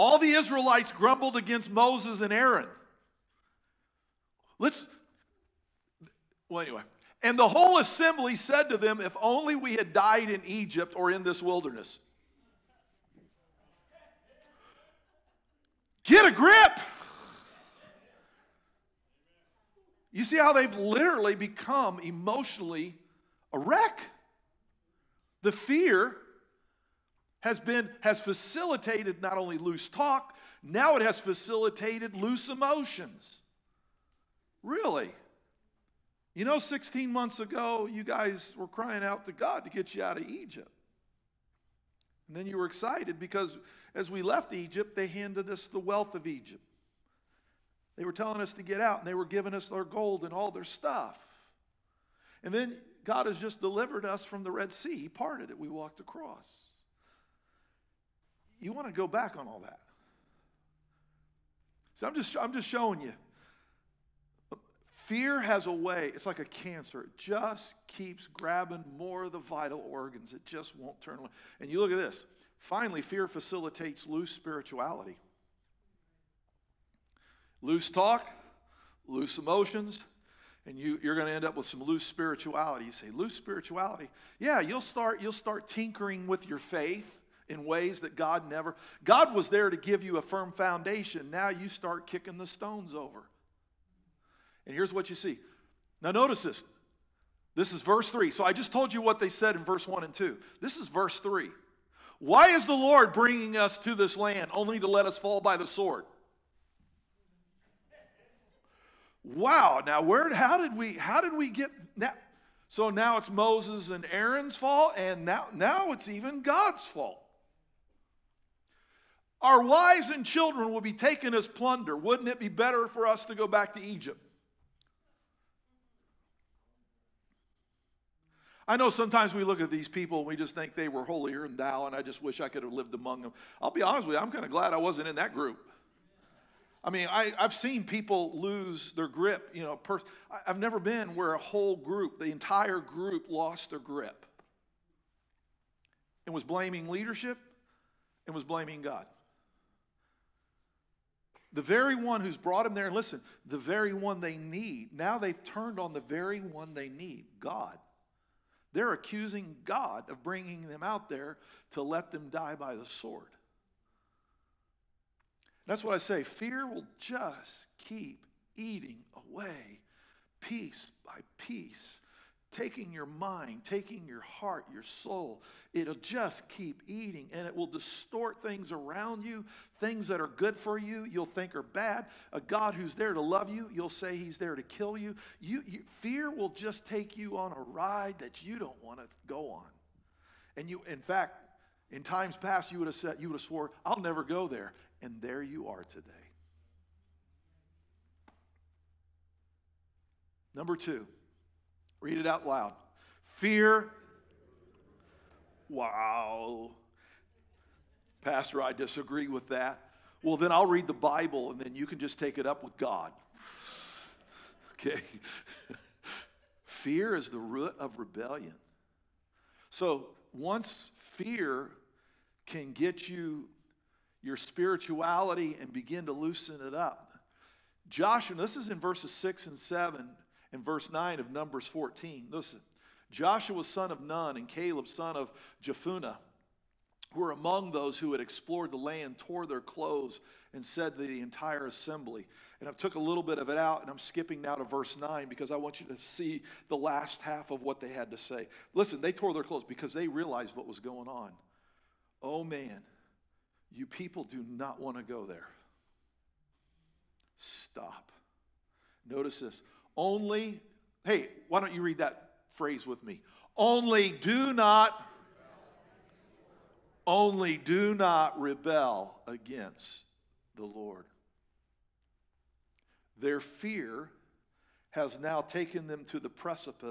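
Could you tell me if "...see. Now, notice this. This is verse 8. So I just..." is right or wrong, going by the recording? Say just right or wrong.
wrong.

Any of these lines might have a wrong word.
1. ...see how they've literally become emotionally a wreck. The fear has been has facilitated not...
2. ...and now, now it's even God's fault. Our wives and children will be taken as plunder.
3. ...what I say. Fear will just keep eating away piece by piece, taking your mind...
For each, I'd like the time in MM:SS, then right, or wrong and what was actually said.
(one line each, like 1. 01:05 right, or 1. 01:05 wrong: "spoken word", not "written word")
1. 00:20 right
2. 01:54 right
3. 02:45 right.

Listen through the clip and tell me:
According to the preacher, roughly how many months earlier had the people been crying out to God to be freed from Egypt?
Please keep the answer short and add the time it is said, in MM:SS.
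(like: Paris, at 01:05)
16, at 00:36.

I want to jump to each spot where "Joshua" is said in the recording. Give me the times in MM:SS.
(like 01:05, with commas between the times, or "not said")
03:47, 03:53.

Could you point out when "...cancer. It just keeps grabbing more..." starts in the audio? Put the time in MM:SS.
01:06.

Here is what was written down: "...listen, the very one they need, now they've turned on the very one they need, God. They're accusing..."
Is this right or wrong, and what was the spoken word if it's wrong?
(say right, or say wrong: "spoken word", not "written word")
right.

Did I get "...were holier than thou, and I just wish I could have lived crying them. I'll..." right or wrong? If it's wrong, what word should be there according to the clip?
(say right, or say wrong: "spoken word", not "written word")
wrong: "among", not "crying".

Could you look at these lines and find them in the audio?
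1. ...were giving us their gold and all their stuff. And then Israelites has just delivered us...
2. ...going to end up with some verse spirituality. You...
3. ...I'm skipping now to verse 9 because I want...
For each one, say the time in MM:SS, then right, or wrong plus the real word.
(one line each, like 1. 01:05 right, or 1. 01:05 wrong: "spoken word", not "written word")
1. 00:49 wrong: "God", not "Israelites"
2. 01:21 wrong: "loose", not "verse"
3. 04:03 right.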